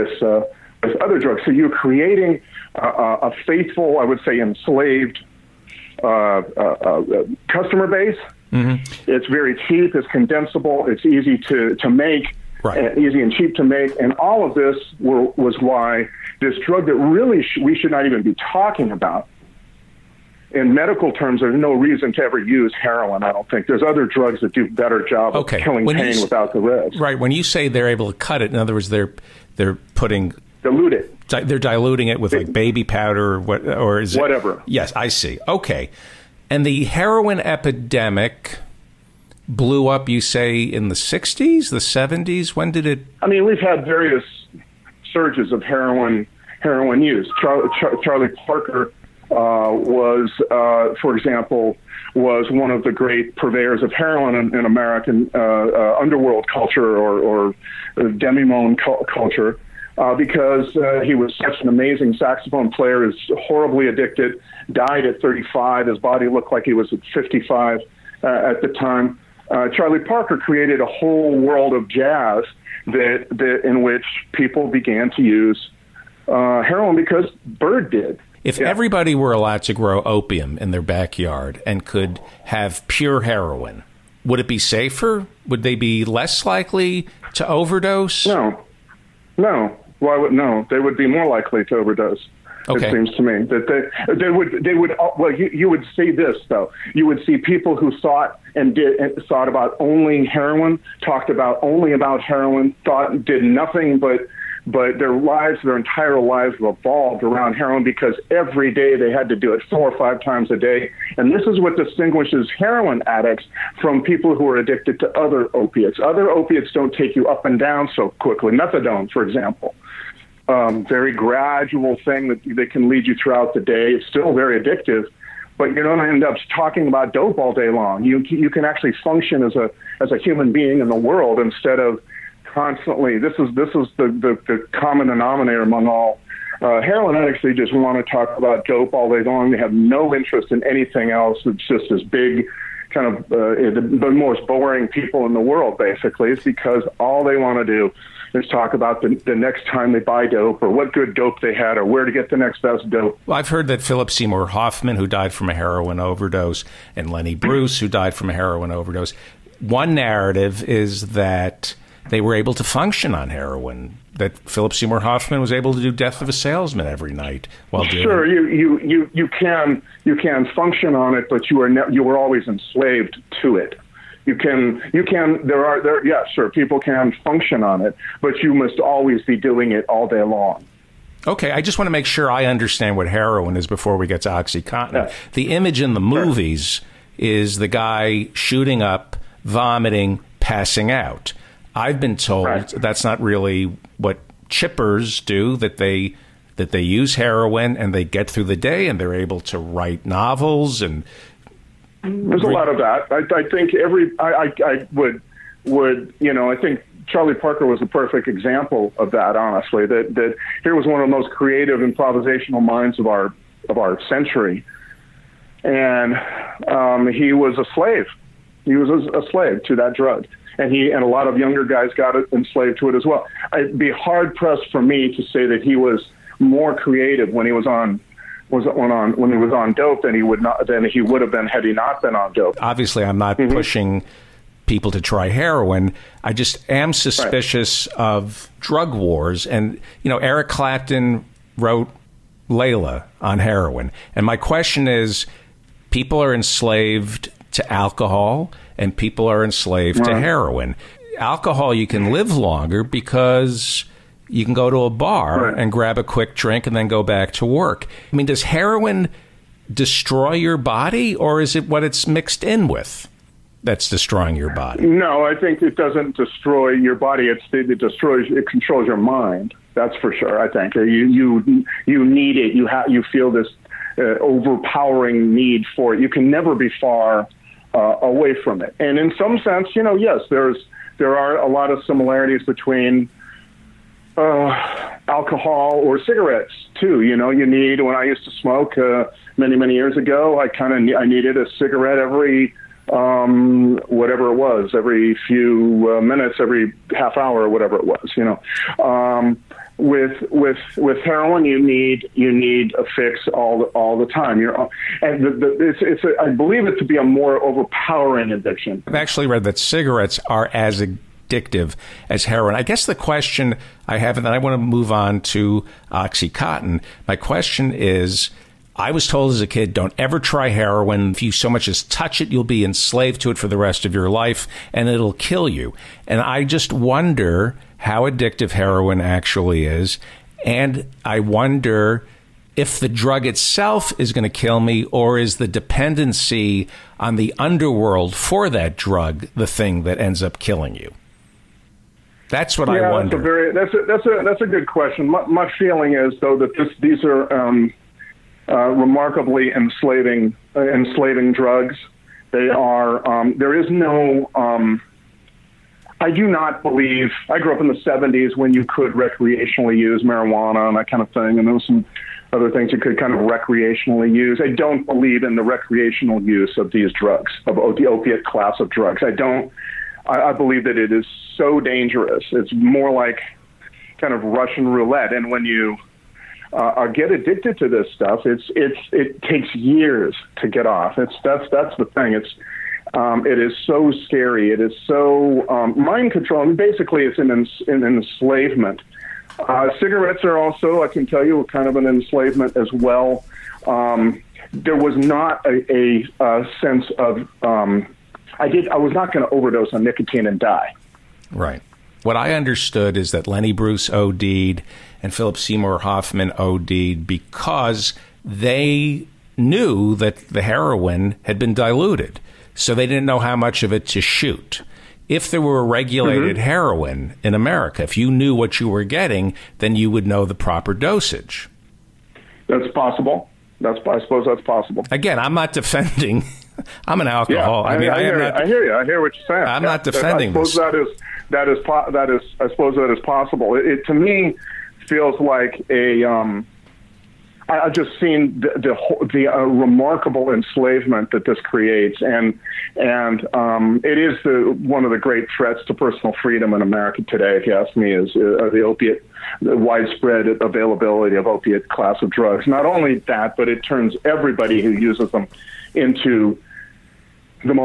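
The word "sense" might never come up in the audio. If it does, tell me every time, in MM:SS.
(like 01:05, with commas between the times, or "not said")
04:39, 06:36.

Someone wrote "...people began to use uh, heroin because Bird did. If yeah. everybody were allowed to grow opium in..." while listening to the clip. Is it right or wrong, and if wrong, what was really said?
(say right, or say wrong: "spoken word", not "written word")
right.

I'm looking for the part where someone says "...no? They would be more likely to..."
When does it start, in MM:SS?
01:30.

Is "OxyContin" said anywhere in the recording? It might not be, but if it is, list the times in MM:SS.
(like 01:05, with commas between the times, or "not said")
03:04, 05:15.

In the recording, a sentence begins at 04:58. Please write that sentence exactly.
You know, um, with with with heroin, you need you need a fix all the, all the time.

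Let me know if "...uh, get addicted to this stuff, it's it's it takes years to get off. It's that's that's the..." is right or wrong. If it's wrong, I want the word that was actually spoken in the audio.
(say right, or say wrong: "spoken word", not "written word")
right.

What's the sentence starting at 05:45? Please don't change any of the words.
My, my feeling is though that this, these are um, uh, remarkably enslaving uh, enslaving drugs.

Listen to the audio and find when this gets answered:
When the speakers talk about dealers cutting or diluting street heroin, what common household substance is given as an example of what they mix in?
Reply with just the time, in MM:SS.
00:32.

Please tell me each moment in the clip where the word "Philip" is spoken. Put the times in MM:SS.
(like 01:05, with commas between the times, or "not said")
02:33, 02:44, 06:45.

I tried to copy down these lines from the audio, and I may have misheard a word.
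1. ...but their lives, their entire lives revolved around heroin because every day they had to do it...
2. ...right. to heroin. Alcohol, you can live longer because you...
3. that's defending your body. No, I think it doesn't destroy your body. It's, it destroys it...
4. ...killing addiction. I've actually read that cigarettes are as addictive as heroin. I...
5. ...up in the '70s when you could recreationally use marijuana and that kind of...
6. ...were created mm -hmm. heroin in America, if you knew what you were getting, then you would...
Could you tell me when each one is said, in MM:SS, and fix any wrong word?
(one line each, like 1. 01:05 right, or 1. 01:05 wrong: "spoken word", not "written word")
1. 01:44 right
2. 04:09 right
3. 04:23 wrong: "destroying", not "defending"
4. 05:07 wrong: "overpowering", not "killing"
5. 05:57 right
6. 06:55 wrong: "regulated", not "created".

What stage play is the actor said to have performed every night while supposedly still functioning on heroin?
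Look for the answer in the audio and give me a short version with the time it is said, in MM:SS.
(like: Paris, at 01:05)
Death of a Salesman, at 02:45.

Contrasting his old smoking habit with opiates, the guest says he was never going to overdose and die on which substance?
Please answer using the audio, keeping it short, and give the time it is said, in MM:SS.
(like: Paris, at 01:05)
nicotine, at 06:39.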